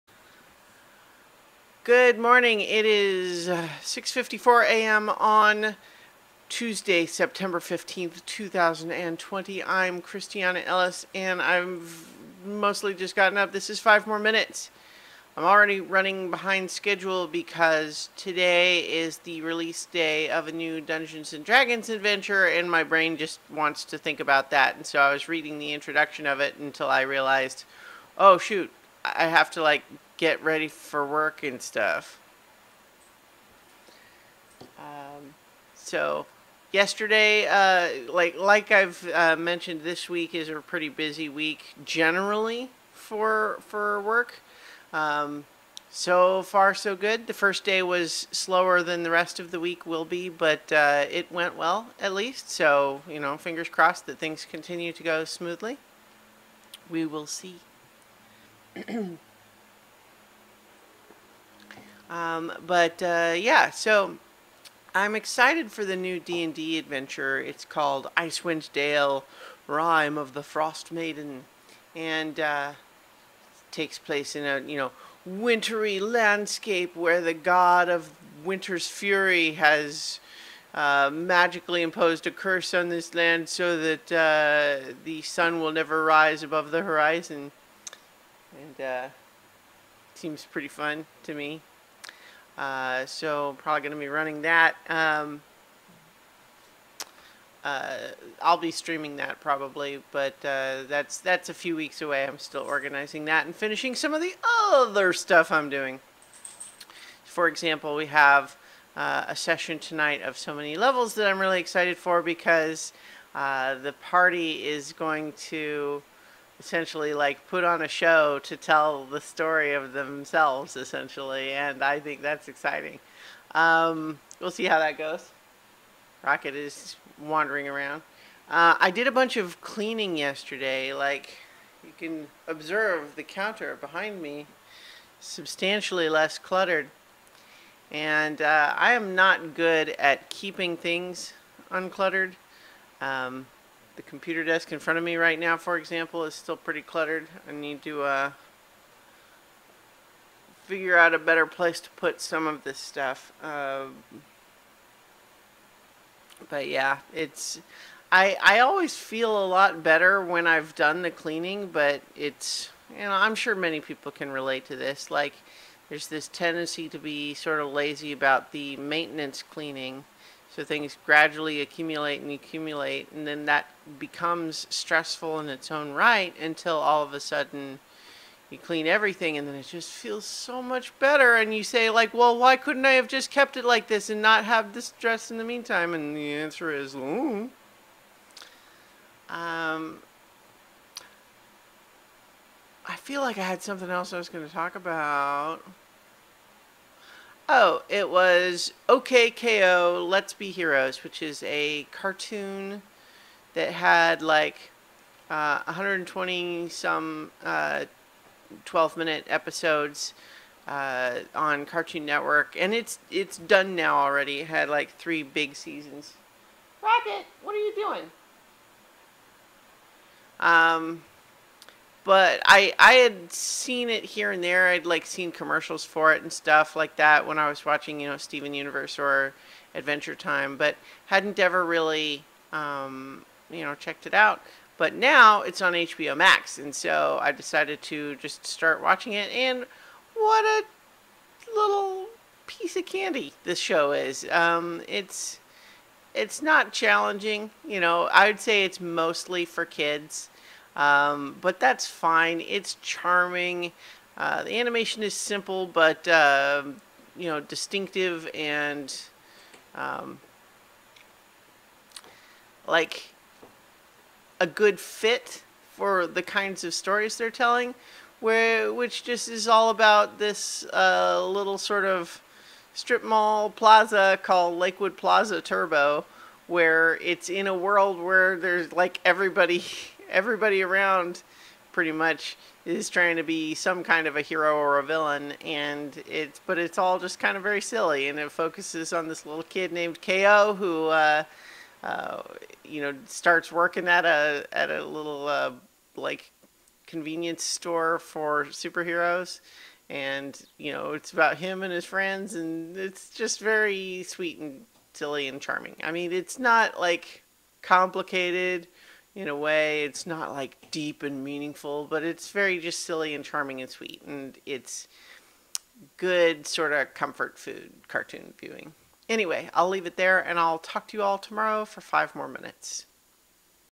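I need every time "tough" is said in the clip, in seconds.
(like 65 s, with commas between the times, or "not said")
not said.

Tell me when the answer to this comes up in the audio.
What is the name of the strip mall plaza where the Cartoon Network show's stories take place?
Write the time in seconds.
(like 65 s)
274 s.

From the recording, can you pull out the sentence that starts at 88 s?
And uh, seems pretty fun to me.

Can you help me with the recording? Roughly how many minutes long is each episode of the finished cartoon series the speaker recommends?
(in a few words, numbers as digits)
12.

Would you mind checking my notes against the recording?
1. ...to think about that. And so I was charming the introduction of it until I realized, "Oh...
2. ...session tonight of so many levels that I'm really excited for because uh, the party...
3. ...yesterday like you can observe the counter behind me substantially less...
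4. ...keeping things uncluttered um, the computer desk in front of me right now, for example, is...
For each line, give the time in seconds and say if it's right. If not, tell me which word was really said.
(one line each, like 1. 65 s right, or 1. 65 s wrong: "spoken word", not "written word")
1. 23 s wrong: "reading", not "charming"
2. 109 s right
3. 130 s right
4. 140 s right.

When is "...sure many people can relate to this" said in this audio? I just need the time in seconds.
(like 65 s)
163 s.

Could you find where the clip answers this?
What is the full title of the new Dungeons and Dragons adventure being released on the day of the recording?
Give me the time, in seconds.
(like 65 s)
68 s.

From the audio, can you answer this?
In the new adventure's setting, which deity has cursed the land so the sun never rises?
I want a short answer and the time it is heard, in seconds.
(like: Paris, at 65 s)
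The god of winter, at 77 s.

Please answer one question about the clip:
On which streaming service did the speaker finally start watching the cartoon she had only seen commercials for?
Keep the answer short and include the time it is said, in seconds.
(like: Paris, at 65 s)
HBO Max, at 235 s.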